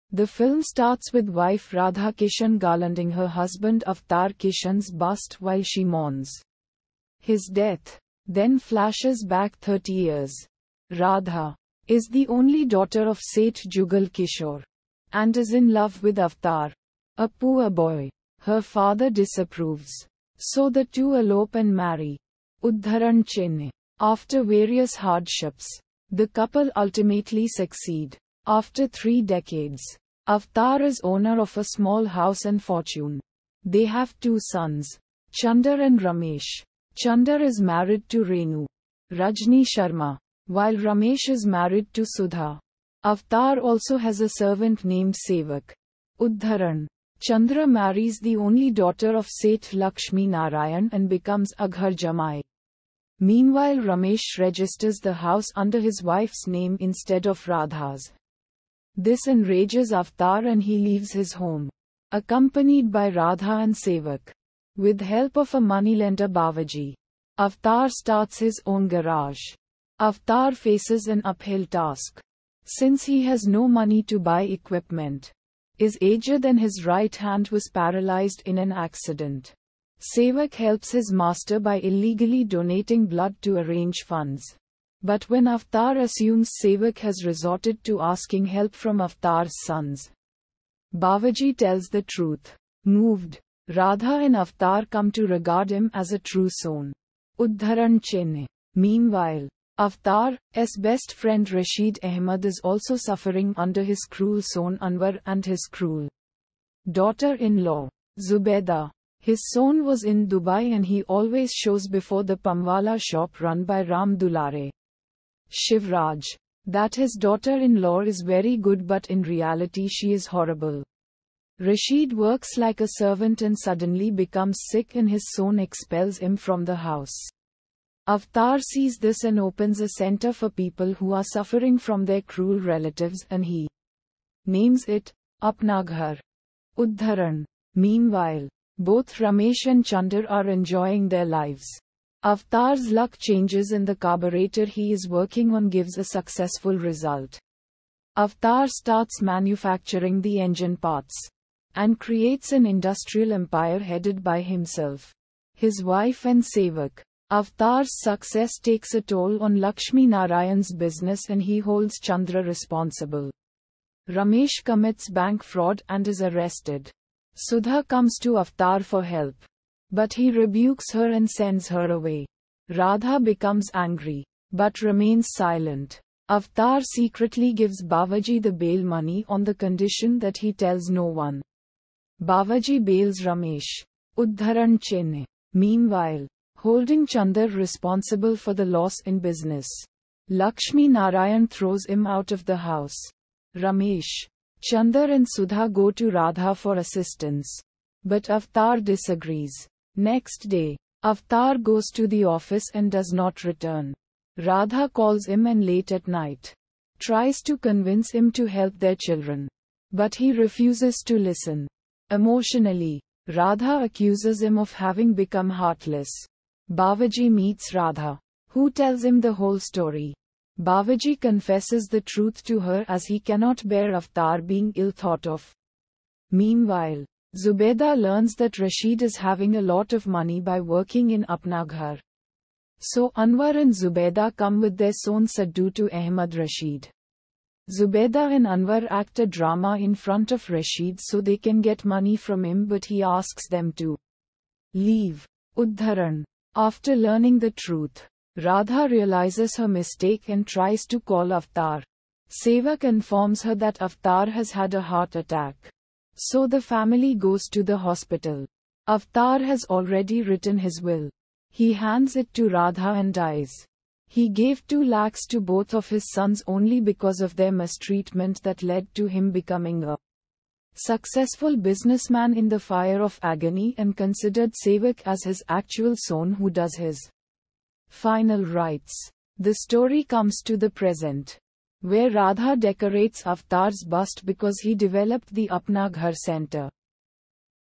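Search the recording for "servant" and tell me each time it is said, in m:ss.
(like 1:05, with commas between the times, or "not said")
0:44, 2:02.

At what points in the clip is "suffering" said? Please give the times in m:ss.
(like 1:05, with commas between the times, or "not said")
1:42, 2:11.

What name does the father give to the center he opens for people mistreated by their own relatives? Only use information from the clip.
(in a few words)
Apnaghar.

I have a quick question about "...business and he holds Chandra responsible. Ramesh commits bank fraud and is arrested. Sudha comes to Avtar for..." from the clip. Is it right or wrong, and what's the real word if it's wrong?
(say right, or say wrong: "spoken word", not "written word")
right.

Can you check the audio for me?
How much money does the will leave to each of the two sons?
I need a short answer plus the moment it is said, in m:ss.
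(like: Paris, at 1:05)
2 lakhs, at 4:24.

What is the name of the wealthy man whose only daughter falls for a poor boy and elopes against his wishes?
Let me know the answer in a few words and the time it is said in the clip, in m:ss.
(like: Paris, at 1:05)
Seth Jugal Kishore, at 0:13.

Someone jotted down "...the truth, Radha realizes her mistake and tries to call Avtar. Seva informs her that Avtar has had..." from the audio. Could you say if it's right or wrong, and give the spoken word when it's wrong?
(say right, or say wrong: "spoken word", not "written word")
right.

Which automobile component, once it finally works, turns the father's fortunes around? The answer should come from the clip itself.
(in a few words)
carburetor.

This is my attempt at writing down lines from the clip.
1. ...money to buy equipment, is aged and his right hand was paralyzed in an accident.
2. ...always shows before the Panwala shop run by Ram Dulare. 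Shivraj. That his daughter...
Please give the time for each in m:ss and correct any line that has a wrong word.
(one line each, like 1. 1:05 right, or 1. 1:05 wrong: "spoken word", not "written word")
1. 1:13 right
2. 1:51 right.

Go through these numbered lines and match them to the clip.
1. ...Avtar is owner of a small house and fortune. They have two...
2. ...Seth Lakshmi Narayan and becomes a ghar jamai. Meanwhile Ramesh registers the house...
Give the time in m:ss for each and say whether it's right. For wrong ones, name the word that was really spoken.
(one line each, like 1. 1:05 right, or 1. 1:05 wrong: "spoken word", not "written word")
1. 0:30 right
2. 0:49 right.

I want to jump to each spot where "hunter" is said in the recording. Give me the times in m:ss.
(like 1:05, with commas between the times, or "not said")
not said.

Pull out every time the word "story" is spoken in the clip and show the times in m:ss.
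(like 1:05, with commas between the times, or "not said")
3:39, 4:39.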